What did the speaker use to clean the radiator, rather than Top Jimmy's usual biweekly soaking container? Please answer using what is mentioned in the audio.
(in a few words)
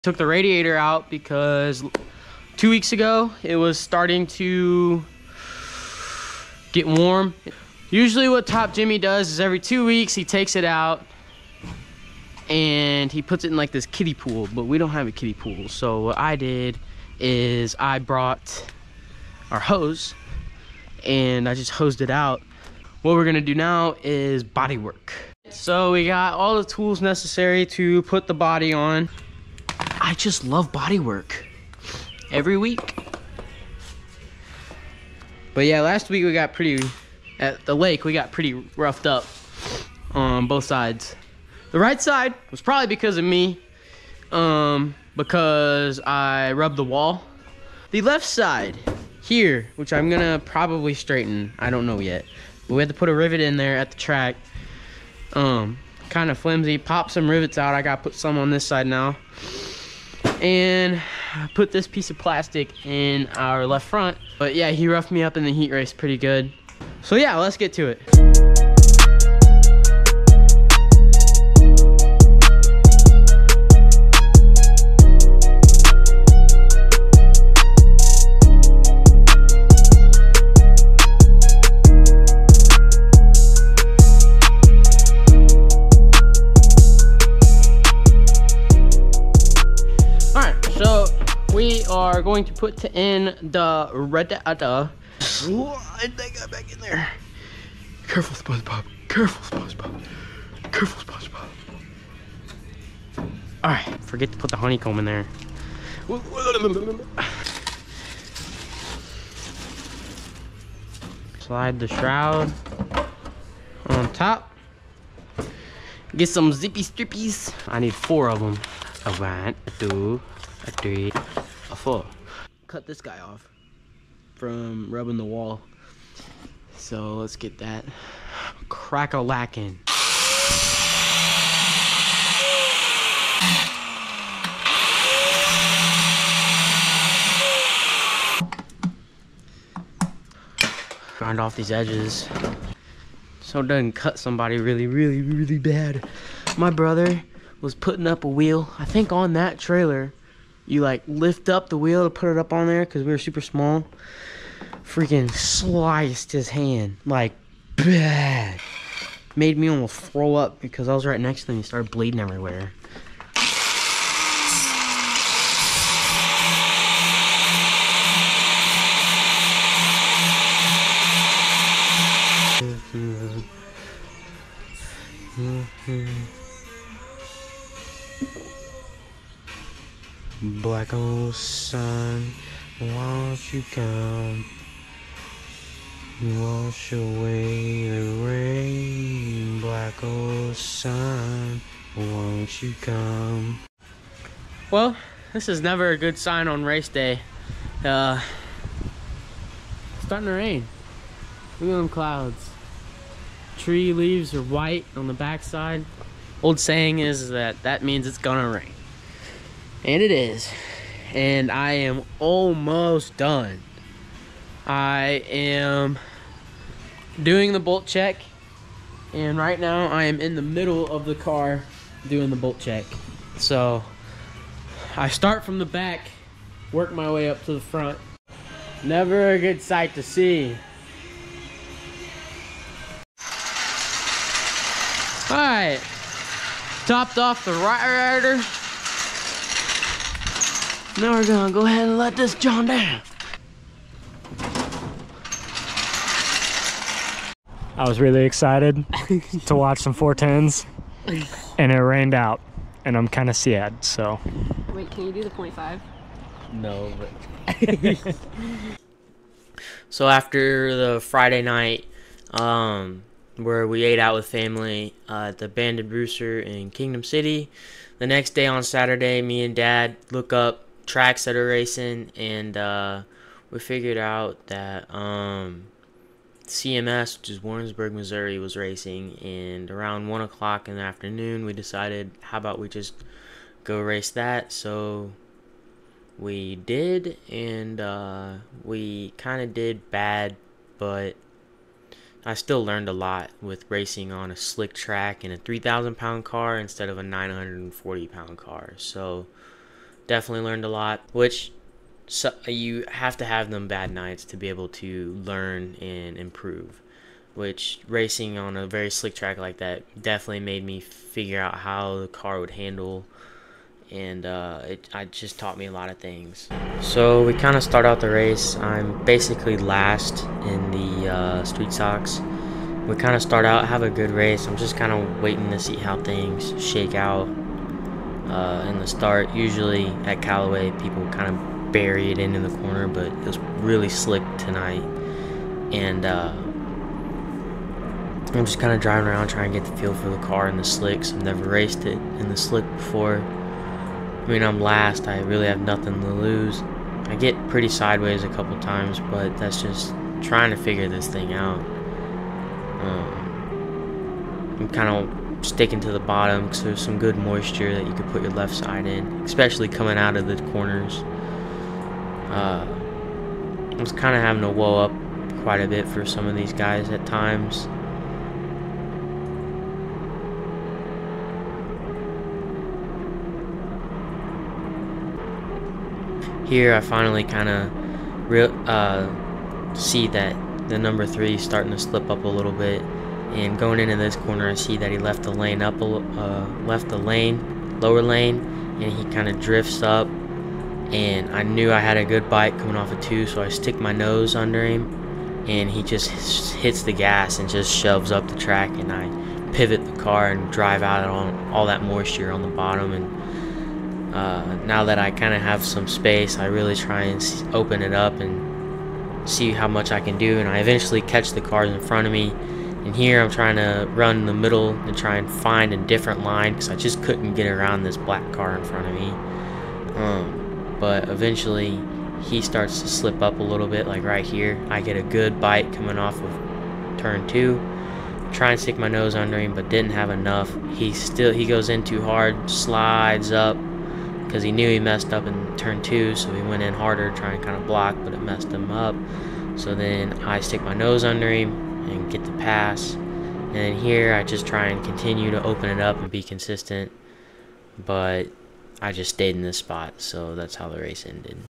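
hose.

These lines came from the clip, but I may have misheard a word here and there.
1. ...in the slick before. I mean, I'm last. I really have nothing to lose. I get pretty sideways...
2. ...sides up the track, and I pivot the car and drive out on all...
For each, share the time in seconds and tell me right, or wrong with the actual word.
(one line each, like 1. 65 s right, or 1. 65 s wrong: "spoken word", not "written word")
1. 341 s right
2. 397 s wrong: "shoves", not "sides".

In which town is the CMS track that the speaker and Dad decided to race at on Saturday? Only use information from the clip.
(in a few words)
Warrensburg.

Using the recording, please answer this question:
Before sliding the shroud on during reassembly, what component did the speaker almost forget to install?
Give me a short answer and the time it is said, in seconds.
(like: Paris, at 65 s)
honeycomb, at 104 s.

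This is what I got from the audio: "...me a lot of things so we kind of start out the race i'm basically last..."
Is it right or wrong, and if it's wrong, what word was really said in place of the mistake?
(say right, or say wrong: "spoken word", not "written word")
right.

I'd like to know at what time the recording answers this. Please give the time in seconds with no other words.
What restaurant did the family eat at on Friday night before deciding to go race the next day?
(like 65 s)
265 s.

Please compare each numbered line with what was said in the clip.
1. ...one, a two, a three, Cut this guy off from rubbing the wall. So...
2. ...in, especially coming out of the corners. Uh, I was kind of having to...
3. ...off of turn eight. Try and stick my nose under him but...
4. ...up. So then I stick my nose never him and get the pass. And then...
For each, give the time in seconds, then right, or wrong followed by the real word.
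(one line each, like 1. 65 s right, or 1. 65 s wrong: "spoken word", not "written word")
1. 119 s right
2. 358 s right
3. 425 s wrong: "two", not "eight"
4. 438 s wrong: "under", not "never".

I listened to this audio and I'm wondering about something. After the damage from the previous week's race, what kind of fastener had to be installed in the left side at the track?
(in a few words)
rivet.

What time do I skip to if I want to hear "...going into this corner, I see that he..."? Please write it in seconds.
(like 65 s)
383 s.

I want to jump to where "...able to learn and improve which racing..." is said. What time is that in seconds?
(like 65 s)
304 s.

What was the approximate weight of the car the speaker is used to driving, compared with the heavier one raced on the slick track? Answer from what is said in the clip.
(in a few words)
940 pounds.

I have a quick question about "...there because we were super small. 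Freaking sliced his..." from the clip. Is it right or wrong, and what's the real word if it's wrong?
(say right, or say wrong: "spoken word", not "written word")
right.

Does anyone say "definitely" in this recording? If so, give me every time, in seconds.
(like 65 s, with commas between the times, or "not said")
300 s, 310 s.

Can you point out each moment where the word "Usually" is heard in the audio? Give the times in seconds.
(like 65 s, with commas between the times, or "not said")
7 s, 329 s.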